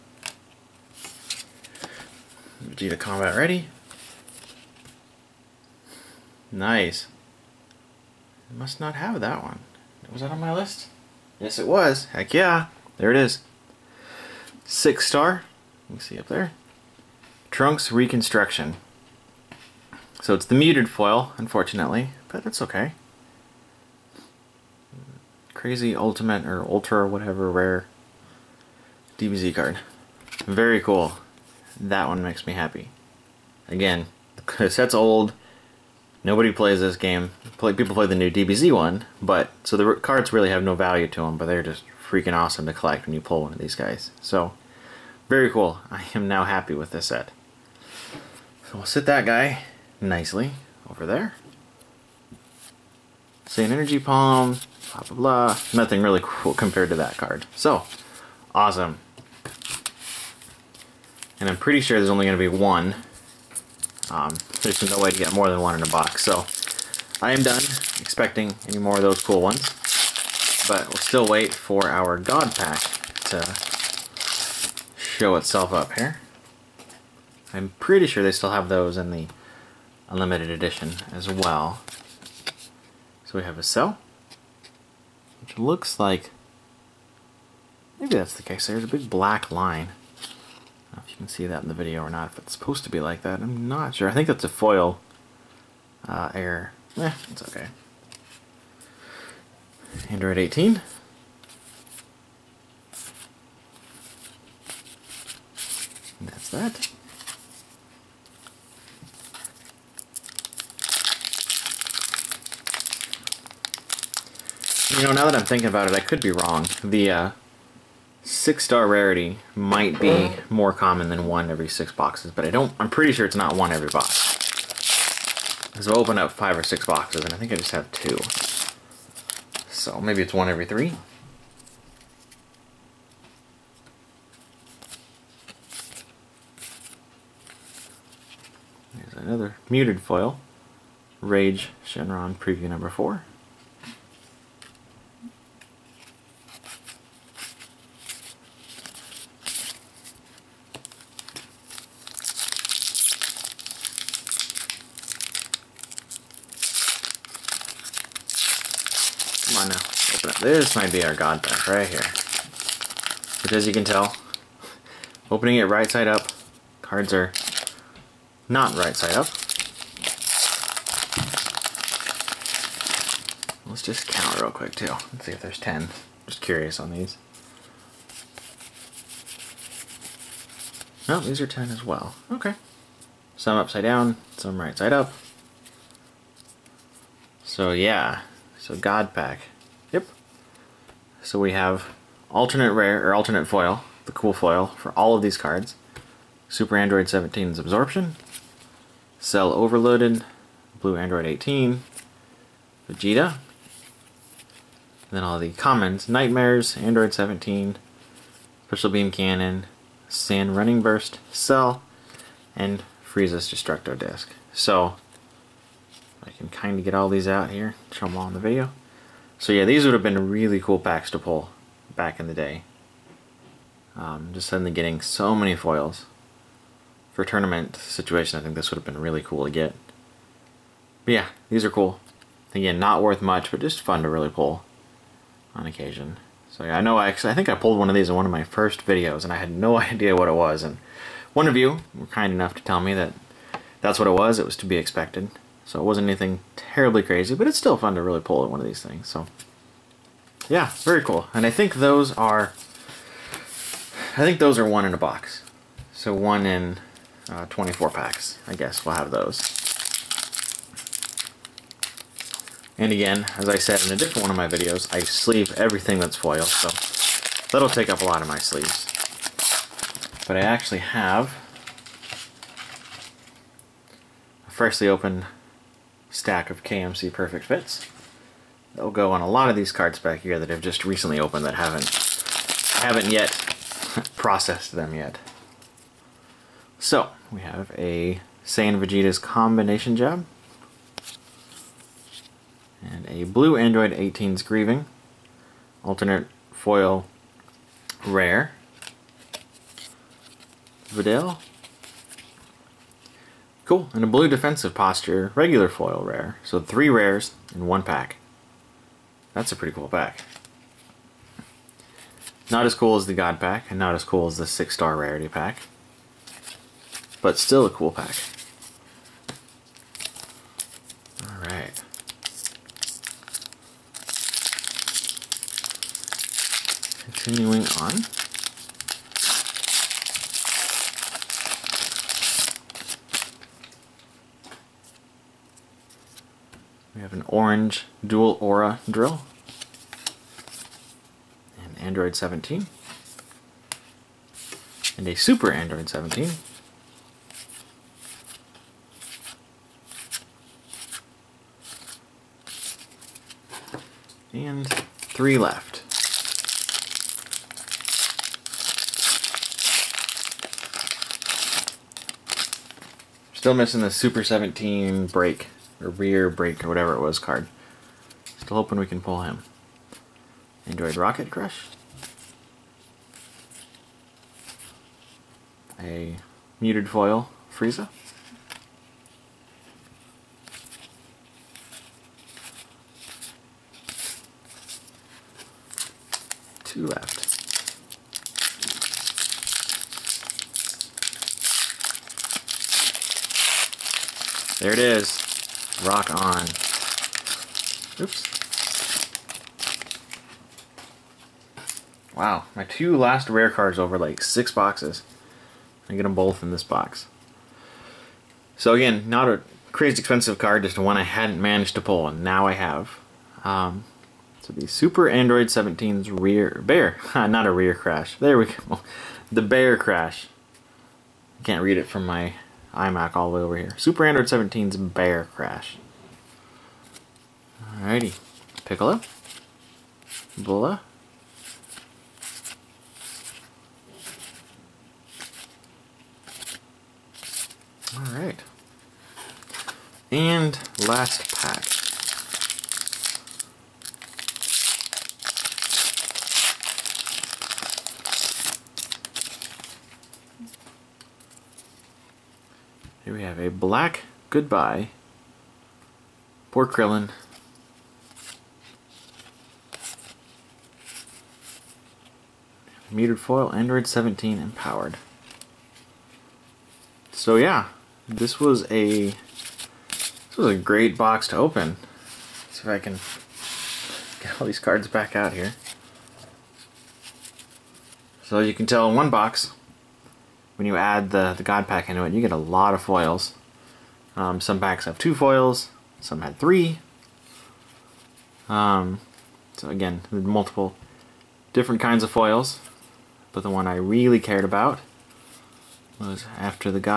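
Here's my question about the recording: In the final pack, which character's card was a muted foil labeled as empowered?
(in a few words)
Android 17.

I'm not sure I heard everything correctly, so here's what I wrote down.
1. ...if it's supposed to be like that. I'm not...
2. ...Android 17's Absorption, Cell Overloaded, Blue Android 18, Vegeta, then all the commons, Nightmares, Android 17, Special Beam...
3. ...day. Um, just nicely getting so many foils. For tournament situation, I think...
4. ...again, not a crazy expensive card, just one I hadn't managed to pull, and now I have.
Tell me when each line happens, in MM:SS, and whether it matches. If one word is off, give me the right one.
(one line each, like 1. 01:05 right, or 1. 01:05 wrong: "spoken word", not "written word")
1. 01:32 right
2. 03:16 right
3. 03:42 wrong: "suddenly", not "nicely"
4. 06:48 right.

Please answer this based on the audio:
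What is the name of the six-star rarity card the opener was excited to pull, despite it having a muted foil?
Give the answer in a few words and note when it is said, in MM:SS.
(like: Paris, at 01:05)
Trunks Reconstruction, at 00:17.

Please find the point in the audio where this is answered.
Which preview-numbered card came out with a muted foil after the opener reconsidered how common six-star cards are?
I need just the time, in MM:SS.
02:21.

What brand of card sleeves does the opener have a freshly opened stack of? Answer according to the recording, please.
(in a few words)
KMC Perfect Fits.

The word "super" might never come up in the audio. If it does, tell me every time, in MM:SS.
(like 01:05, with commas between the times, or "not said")
03:16, 05:45, 06:03, 06:54, 07:03.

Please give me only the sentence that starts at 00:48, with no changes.
So we'll sit that guy nicely over there.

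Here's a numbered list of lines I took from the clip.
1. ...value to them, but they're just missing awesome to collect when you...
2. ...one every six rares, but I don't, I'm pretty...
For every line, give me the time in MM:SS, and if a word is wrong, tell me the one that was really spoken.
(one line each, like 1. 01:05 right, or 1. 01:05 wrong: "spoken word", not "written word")
1. 00:40 wrong: "freaking", not "missing"
2. 02:01 wrong: "boxes", not "rares".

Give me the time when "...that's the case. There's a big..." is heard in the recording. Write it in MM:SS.
01:28.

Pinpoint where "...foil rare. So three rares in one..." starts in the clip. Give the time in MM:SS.
05:05.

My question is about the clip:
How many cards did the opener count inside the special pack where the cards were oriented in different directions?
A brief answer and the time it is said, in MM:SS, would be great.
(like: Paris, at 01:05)
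10, at 02:55.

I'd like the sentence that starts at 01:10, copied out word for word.
But we'll still wait for our God Pack to show itself up here.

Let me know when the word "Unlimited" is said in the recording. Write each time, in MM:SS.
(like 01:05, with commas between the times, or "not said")
01:20.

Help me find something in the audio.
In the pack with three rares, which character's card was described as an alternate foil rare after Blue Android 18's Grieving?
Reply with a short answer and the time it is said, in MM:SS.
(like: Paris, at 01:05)
Videl, at 05:00.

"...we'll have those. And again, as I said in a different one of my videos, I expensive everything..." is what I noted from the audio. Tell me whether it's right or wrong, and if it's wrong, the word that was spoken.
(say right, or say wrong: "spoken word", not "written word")
wrong: "sleeve", not "expensive".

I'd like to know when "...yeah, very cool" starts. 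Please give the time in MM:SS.
04:10.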